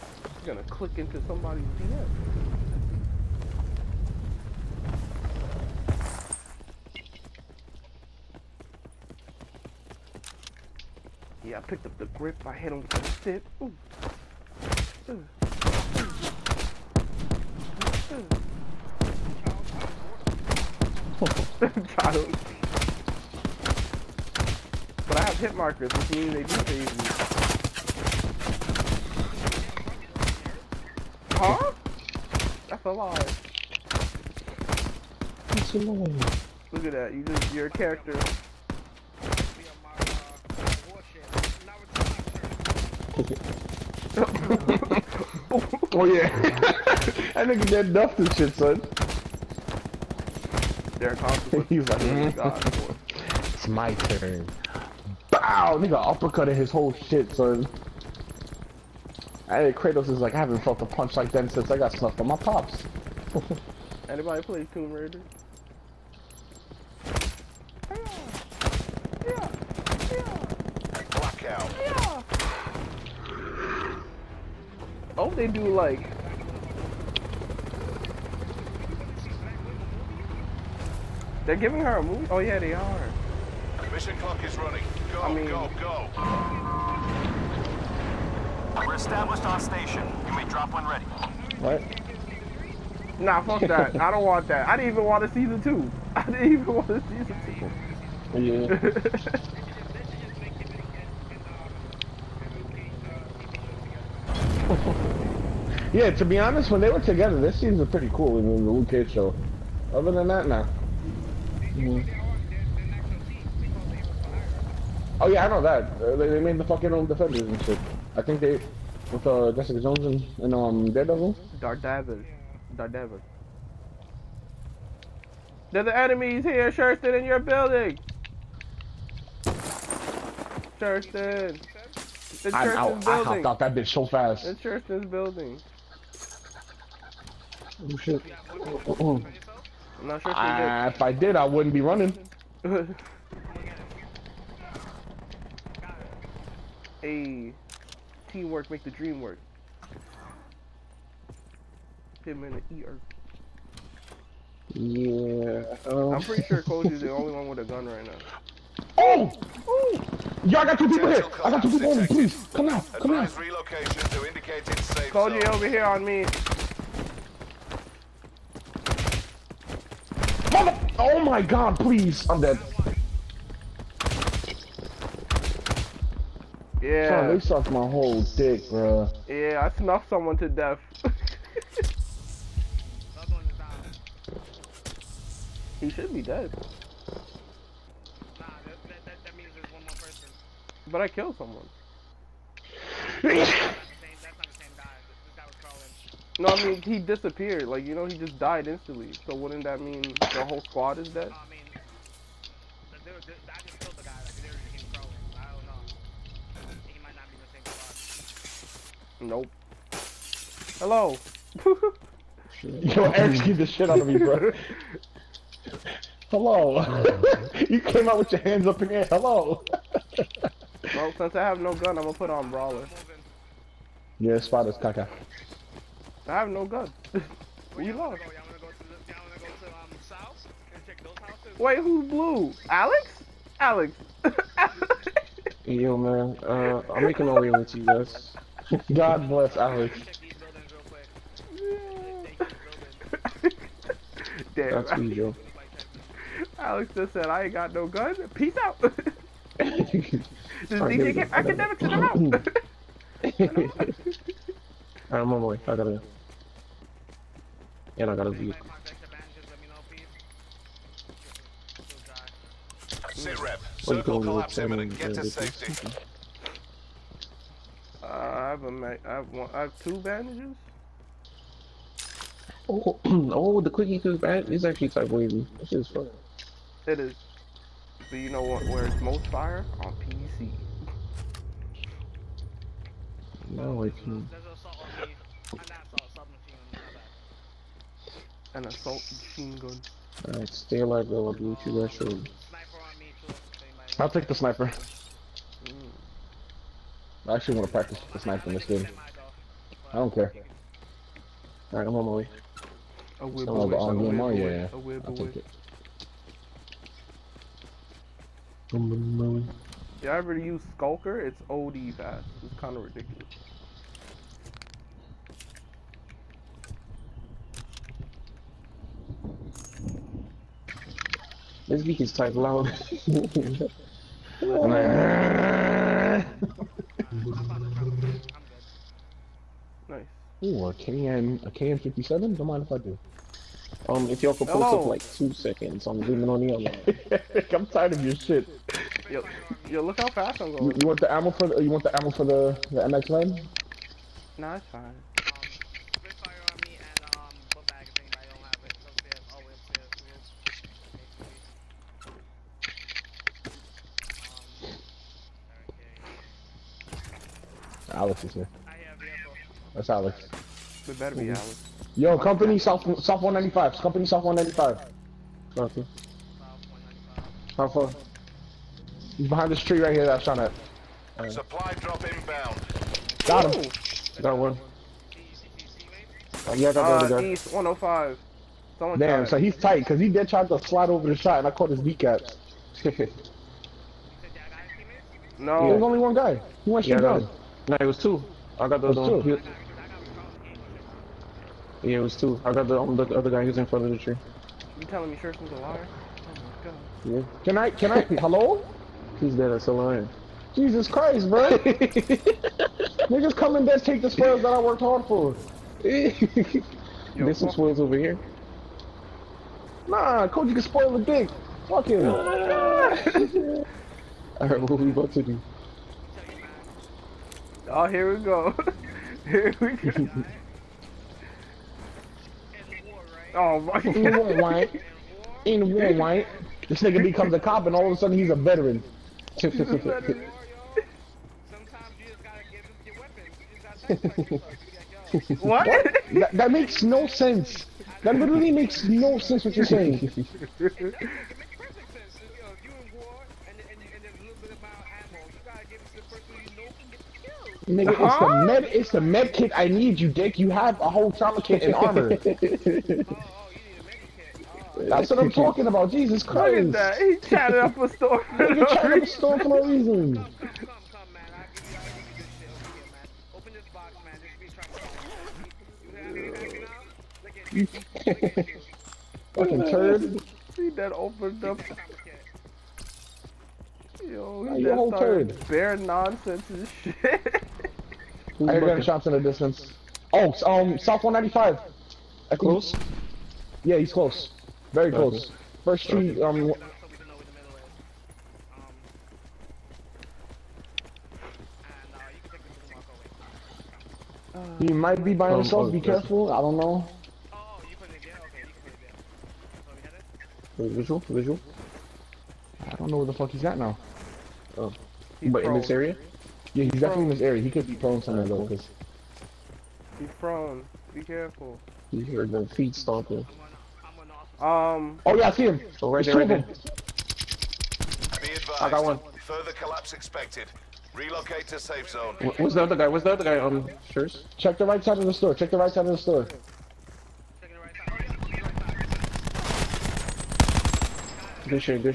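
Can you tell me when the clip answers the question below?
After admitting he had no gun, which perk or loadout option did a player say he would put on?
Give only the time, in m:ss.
3:42.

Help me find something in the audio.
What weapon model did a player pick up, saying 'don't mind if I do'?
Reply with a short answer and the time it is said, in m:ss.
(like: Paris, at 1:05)
KN 57, at 5:31.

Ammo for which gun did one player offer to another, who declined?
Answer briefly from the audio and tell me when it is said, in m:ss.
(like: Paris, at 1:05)
MX9, at 5:42.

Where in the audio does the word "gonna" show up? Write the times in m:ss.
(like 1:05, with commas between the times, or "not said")
0:00, 3:42.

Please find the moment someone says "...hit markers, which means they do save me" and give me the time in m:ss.
0:25.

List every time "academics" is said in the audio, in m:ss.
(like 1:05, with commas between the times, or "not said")
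4:11.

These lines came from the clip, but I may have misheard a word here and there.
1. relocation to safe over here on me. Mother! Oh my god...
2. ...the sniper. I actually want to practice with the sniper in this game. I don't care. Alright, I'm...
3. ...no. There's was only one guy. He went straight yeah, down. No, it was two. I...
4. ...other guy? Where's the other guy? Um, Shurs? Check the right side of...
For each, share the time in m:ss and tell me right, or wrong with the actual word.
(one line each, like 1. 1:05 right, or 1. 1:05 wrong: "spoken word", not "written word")
1. 2:43 right
2. 4:54 right
3. 6:22 right
4. 8:42 right.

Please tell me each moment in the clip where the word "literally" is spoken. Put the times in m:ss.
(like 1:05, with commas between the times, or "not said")
7:18.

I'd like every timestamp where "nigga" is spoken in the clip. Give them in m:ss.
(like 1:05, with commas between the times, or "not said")
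0:55, 6:43, 7:06, 7:27, 7:38.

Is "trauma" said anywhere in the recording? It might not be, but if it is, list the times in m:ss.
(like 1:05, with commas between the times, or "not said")
7:31.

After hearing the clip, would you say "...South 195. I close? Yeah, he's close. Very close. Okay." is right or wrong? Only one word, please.
right.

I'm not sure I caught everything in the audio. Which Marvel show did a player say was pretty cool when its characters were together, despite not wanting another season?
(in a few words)
Luke Cage.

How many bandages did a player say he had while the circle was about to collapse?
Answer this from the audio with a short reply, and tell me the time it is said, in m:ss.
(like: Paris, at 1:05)
2, at 4:29.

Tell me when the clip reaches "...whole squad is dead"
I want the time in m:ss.
3:20.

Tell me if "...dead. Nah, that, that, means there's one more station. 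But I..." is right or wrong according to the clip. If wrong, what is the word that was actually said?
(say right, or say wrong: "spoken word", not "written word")
wrong: "person", not "station".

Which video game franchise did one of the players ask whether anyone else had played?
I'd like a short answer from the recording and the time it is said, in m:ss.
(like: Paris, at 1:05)
Tomb Raider, at 1:04.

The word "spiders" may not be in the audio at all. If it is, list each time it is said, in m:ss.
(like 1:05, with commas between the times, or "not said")
3:44.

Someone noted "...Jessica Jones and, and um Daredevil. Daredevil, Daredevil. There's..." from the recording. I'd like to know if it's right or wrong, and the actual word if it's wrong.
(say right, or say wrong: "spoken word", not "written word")
right.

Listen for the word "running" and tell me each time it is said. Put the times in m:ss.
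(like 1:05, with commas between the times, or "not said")
1:24, 2:21.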